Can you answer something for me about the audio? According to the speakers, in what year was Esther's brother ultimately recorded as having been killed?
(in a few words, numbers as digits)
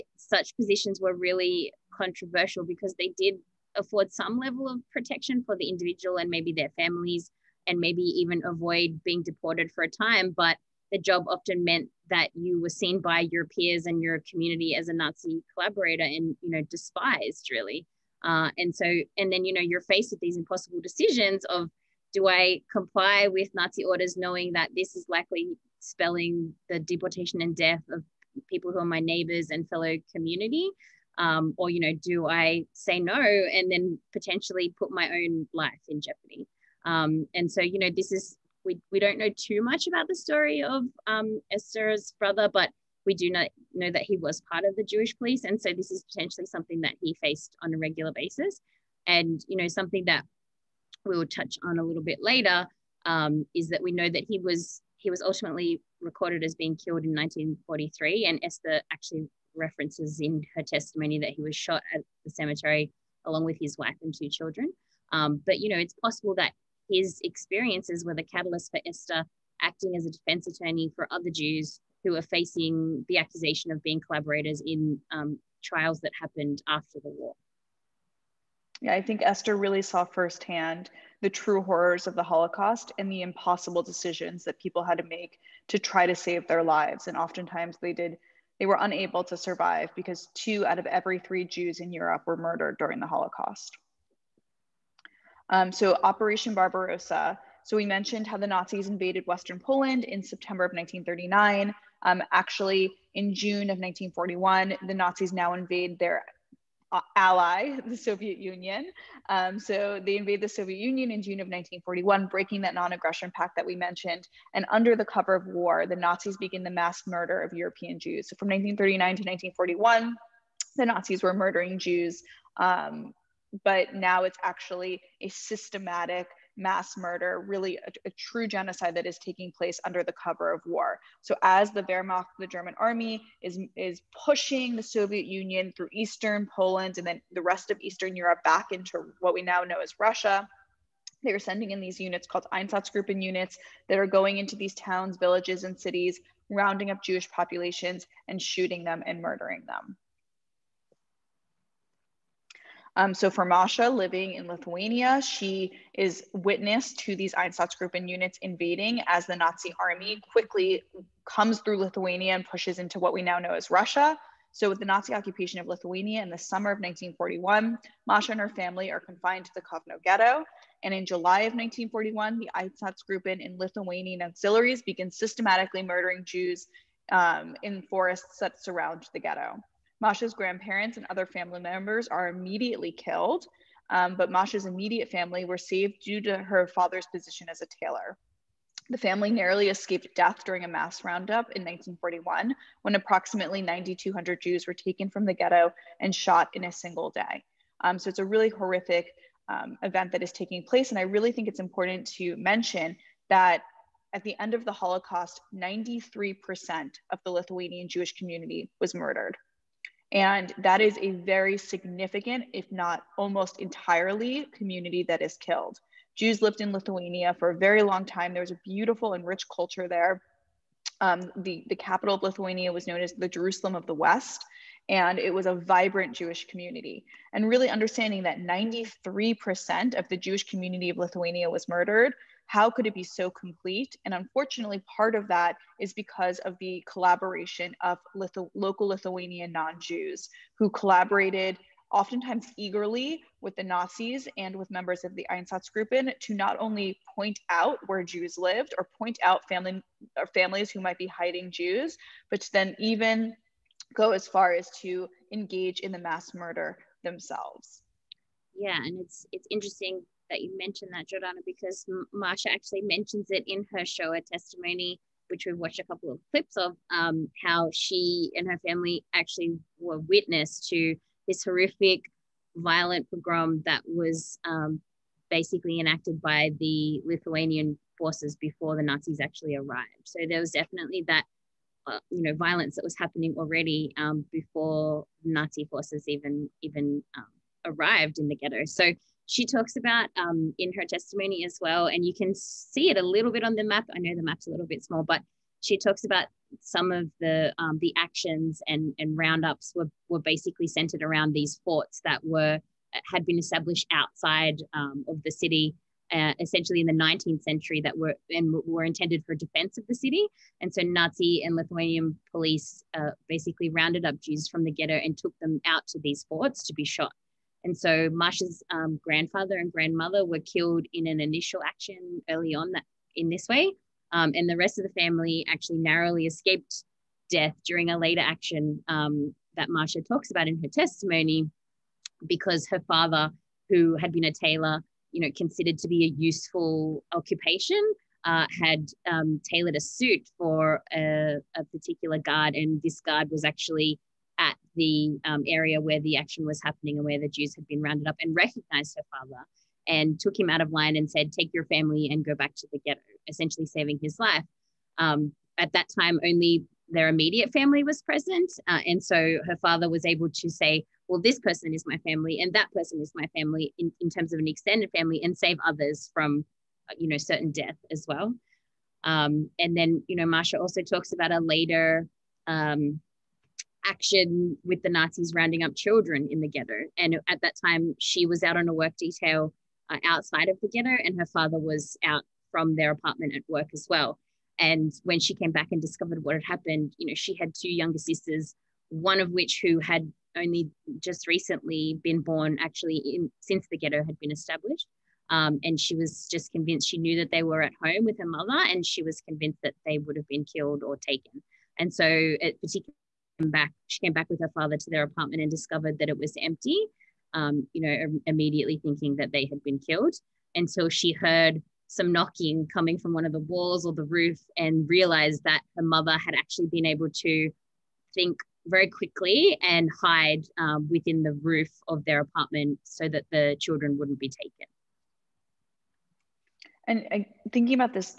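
1943.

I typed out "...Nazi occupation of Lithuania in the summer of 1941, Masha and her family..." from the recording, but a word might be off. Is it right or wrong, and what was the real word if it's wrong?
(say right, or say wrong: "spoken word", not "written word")
right.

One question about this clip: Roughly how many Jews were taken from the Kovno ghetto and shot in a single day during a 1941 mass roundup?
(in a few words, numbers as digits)
9,200.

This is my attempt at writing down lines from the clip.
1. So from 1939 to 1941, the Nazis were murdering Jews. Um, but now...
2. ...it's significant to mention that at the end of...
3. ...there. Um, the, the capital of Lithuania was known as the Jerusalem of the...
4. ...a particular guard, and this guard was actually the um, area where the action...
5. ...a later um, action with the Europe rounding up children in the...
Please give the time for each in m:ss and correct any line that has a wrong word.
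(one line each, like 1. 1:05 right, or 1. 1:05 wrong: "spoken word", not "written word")
1. 1:58 right
2. 3:21 wrong: "important", not "significant"
3. 3:39 right
4. 5:41 right
5. 6:11 wrong: "Nazis", not "Europe".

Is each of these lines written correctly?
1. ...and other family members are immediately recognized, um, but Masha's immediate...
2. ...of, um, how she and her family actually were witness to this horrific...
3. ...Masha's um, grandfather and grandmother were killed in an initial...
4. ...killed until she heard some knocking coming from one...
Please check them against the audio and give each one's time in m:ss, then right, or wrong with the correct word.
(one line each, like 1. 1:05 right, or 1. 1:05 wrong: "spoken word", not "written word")
1. 3:00 wrong: "killed", not "recognized"
2. 4:26 right
3. 5:18 right
4. 6:49 right.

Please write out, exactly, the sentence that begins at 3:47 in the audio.
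And really understanding that 93% of the Jewish community of Lithuania was murdered how could it be so complete?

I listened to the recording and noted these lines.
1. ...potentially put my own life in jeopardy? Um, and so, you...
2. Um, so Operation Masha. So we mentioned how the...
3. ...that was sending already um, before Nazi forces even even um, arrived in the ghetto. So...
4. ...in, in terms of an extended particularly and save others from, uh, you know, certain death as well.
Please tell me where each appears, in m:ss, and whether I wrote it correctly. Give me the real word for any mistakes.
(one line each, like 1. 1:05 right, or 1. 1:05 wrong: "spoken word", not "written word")
1. 0:34 right
2. 1:35 wrong: "Barbarossa", not "Masha"
3. 4:42 wrong: "happening", not "sending"
4. 6:03 wrong: "family", not "particularly".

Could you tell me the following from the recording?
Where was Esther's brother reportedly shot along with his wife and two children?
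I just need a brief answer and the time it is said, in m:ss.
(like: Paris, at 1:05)
the cemetery, at 1:02.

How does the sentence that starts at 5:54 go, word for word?
Um, at that time, only their immediate family was present.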